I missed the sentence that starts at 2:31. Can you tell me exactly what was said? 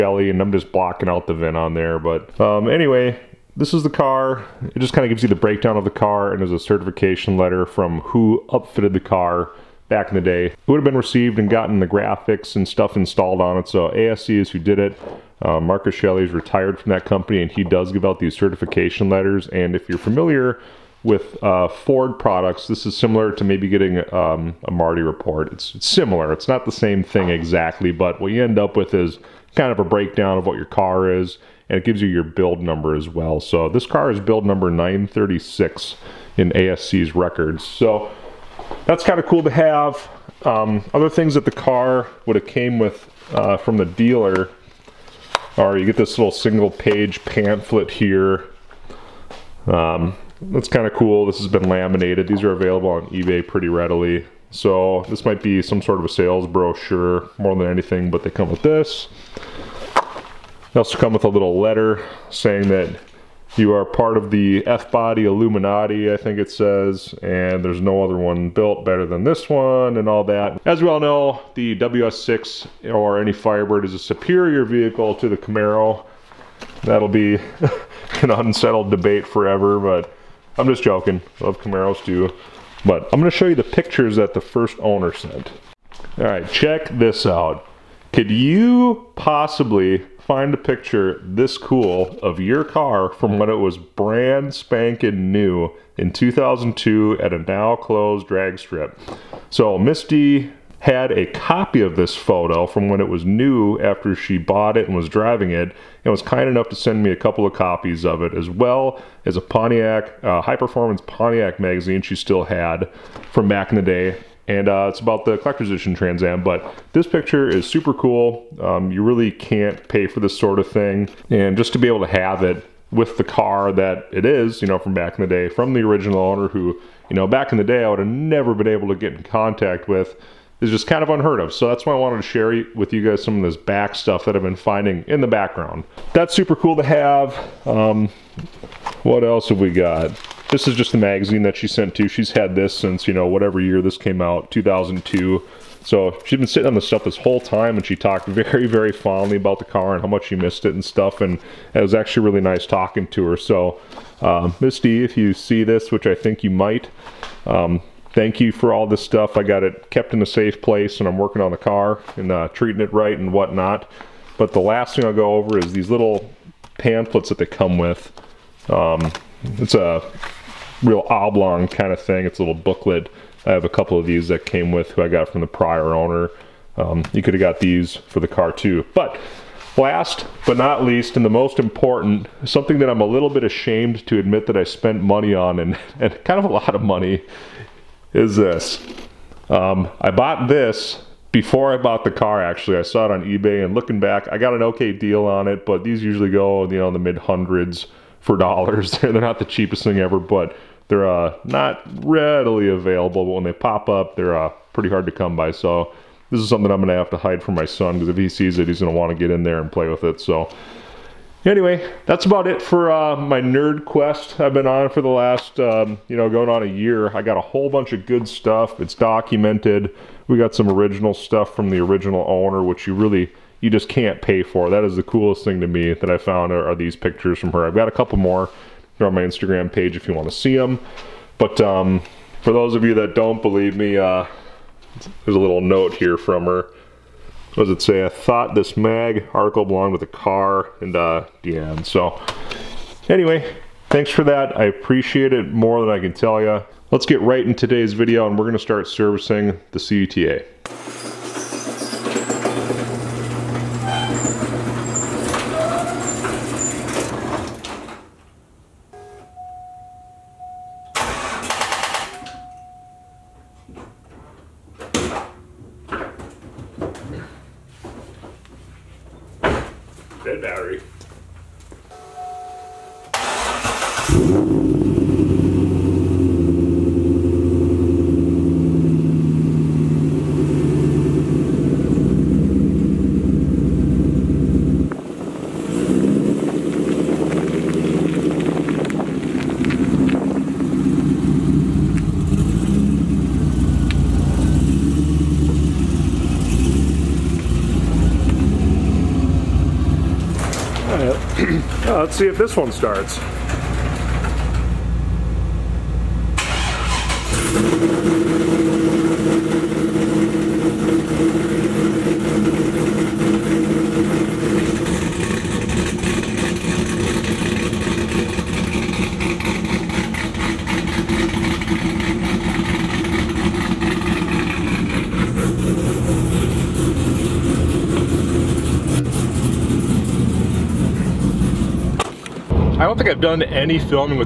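And it was actually really nice talking to her.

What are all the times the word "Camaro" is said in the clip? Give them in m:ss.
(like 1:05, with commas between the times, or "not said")
1:15, 1:21.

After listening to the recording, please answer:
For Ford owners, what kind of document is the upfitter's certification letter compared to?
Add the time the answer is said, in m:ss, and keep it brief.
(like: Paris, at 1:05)
Marti report, at 0:24.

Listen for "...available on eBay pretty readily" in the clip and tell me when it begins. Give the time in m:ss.
0:52.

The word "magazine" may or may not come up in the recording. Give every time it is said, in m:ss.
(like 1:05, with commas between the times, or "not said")
1:51, 2:20.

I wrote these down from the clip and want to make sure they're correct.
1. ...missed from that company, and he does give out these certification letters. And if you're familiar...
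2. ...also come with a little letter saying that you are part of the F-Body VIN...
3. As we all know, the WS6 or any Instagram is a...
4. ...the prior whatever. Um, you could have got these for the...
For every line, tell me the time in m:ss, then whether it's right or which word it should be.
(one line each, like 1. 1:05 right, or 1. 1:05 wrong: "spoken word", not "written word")
1. 0:16 wrong: "retired", not "missed"
2. 1:00 wrong: "Illuminati", not "VIN"
3. 1:10 wrong: "Firebird", not "Instagram"
4. 2:55 wrong: "owner", not "whatever".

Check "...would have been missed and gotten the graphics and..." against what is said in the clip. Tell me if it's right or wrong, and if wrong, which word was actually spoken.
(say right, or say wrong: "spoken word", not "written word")
wrong: "received", not "missed".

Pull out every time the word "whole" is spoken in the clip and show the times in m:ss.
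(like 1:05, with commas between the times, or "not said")
2:27, 3:37.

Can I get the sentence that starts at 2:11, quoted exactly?
So that's why I wanted to share with you guys some of this back stuff that I've been finding in the background.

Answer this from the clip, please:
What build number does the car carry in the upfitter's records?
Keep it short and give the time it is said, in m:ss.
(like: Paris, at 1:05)
936, at 0:34.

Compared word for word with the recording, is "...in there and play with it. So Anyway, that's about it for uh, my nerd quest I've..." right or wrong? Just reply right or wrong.
right.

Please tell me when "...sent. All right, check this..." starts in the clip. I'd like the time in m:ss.
1:25.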